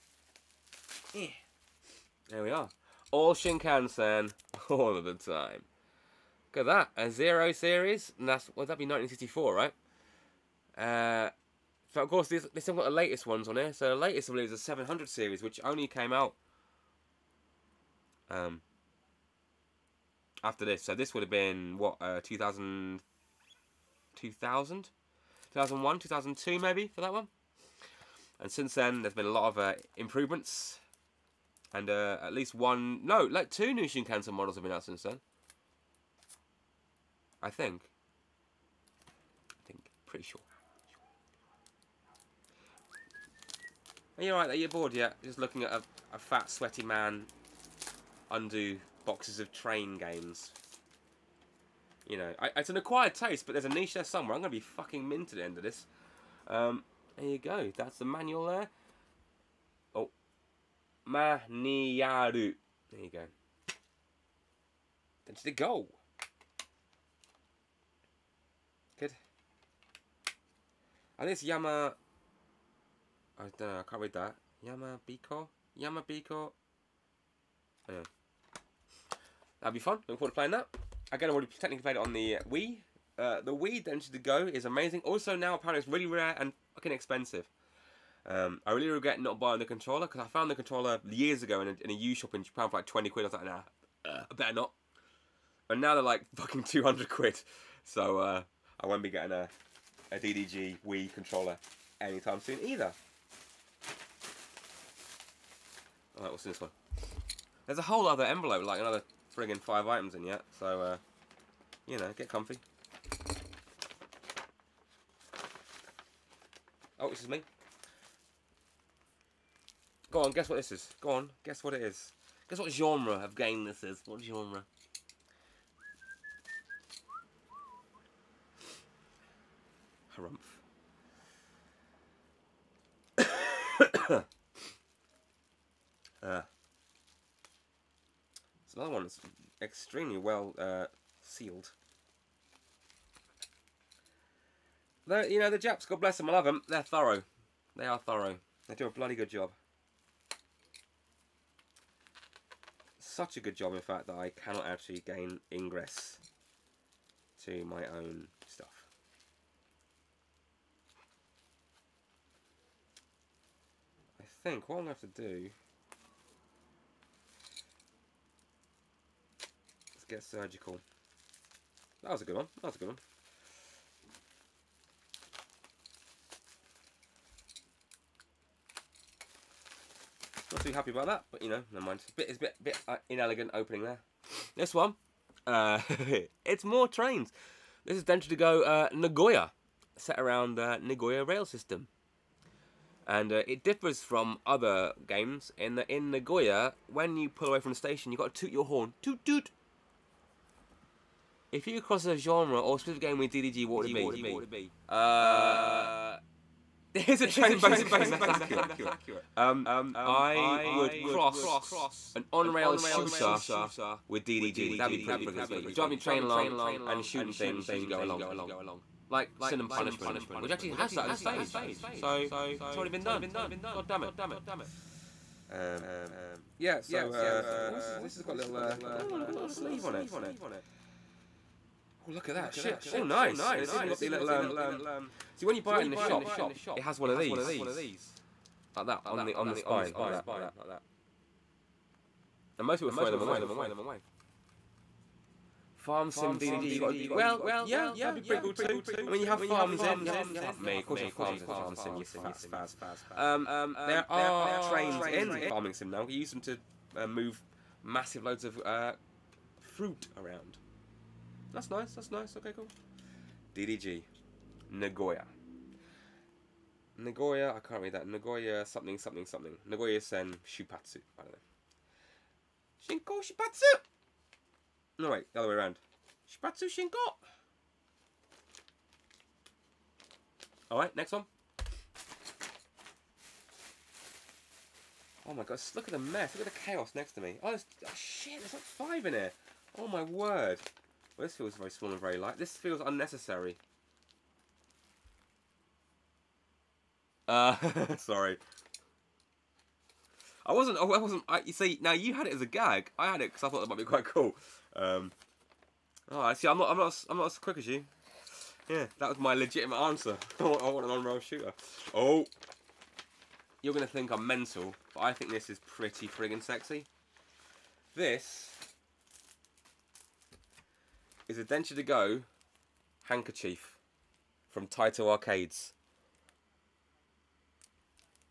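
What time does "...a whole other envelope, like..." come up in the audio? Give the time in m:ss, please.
1:47.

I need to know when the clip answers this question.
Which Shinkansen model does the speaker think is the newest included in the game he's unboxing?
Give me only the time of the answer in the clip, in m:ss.
0:14.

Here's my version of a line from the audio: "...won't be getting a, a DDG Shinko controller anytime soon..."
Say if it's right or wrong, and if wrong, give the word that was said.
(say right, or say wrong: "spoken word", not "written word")
wrong: "Wii", not "Shinko".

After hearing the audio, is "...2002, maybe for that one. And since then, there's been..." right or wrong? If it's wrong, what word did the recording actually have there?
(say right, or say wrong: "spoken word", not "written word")
right.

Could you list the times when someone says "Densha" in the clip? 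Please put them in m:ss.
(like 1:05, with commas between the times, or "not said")
1:23, 3:08, 5:21.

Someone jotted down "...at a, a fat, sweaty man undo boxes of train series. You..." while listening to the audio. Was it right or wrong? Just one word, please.
wrong.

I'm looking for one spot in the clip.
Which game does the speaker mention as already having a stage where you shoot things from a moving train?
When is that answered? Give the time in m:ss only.
3:39.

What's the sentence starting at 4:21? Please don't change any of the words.
That's nice, that's nice, okay, cool.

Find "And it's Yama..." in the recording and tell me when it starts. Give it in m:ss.
1:11.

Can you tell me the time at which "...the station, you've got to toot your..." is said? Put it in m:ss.
3:17.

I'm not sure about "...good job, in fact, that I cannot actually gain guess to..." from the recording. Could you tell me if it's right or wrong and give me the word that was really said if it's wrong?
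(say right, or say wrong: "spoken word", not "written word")
wrong: "ingress", not "guess".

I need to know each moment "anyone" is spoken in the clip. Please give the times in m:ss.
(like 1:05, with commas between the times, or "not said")
not said.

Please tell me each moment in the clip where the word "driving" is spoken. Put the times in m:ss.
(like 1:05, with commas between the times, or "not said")
3:35.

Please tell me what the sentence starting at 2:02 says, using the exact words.
Guess what genre of game this is.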